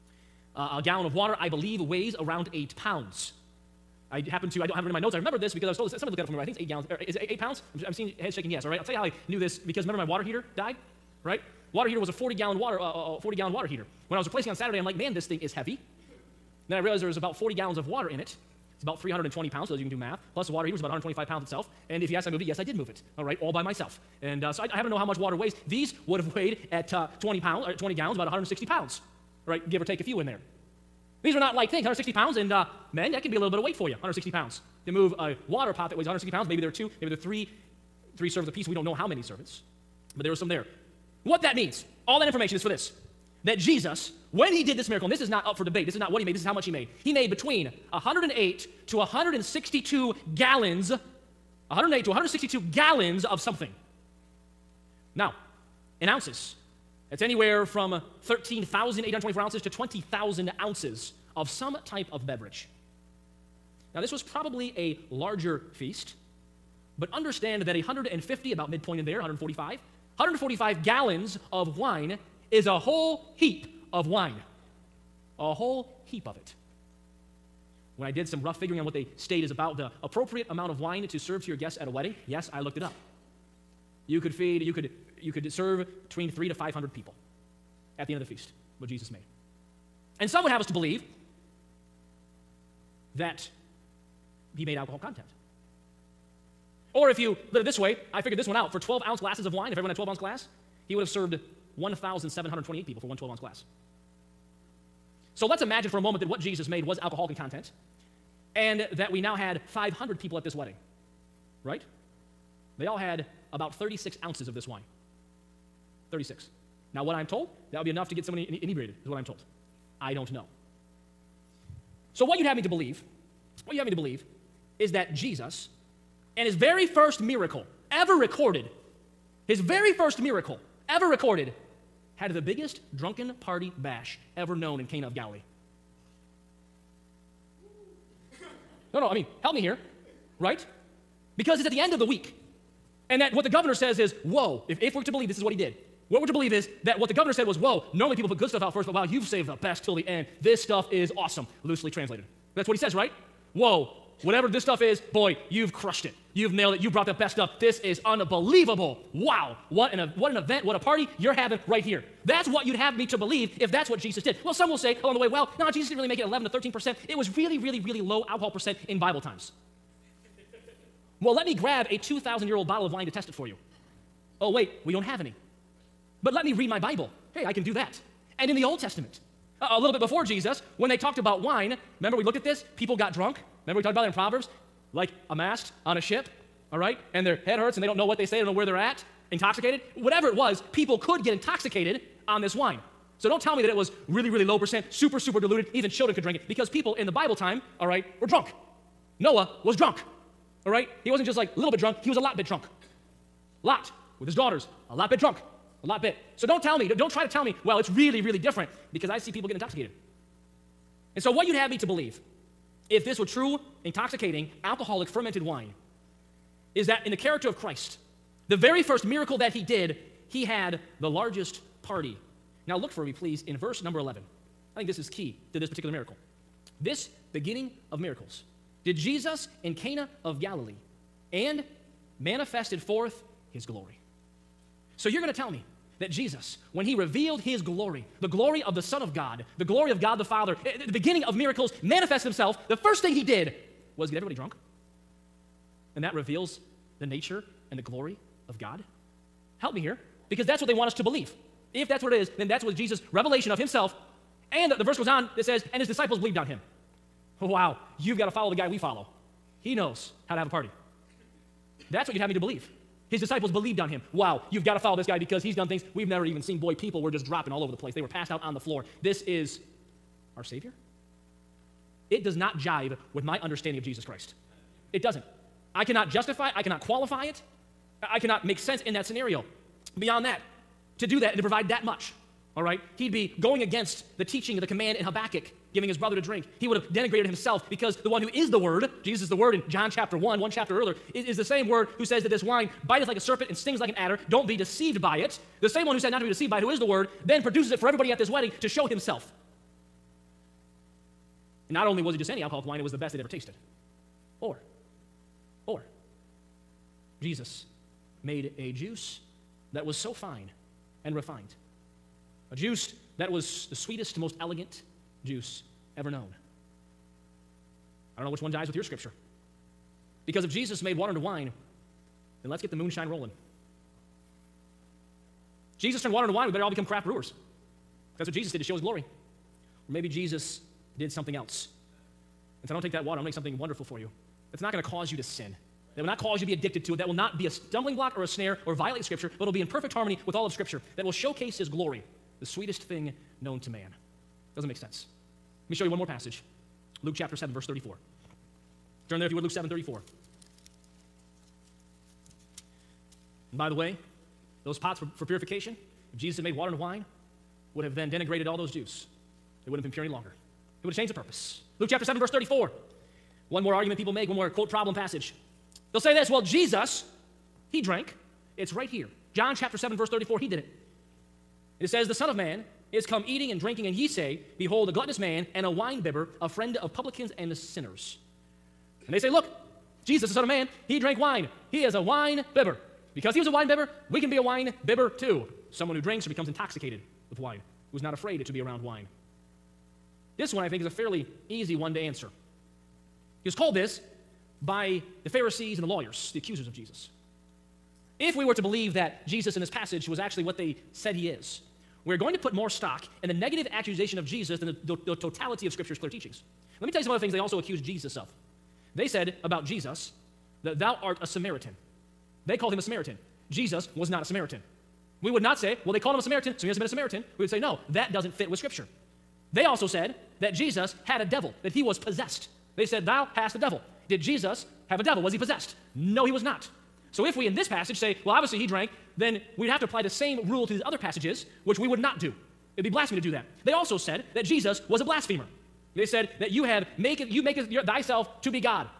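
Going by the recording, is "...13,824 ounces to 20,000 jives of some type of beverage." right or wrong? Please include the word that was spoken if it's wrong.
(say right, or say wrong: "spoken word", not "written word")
wrong: "ounces", not "jives".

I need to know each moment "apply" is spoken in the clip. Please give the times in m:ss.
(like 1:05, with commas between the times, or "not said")
7:09.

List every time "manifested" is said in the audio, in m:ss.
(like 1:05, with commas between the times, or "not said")
3:52, 4:01.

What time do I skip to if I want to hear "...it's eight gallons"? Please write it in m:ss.
0:06.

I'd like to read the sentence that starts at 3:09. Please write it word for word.
Whatever it was, people could get intoxicated on this wine.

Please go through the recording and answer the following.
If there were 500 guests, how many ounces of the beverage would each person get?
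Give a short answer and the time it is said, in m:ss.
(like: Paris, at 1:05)
36 ounces, at 1:53.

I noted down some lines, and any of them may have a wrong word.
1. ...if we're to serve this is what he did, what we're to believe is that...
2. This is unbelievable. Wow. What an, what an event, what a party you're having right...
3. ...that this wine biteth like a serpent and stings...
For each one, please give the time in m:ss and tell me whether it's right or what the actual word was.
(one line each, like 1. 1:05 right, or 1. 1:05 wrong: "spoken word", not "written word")
1. 2:24 wrong: "believe", not "serve"
2. 2:37 right
3. 4:52 right.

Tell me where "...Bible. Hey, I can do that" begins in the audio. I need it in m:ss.
2:56.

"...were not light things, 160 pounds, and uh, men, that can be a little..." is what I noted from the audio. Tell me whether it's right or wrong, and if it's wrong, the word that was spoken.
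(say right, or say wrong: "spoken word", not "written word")
right.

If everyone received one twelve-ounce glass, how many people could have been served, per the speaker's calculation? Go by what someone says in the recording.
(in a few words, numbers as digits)
1,728.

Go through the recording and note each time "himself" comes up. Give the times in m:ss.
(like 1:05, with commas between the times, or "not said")
4:02, 4:13, 4:47, 4:58.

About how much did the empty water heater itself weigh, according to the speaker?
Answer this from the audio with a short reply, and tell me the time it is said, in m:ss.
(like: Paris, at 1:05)
125 pounds, at 0:20.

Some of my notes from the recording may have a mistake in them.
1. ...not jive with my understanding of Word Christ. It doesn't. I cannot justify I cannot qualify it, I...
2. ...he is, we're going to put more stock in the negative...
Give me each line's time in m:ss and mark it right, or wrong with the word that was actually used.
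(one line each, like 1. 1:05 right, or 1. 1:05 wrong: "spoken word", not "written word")
1. 4:32 wrong: "Jesus", not "Word"
2. 6:41 right.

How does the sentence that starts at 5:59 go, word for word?
They wouldn't have been pure any longer.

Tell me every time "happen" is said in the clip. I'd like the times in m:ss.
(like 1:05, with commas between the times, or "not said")
0:04, 0:24.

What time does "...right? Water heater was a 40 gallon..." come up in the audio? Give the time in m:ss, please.
0:11.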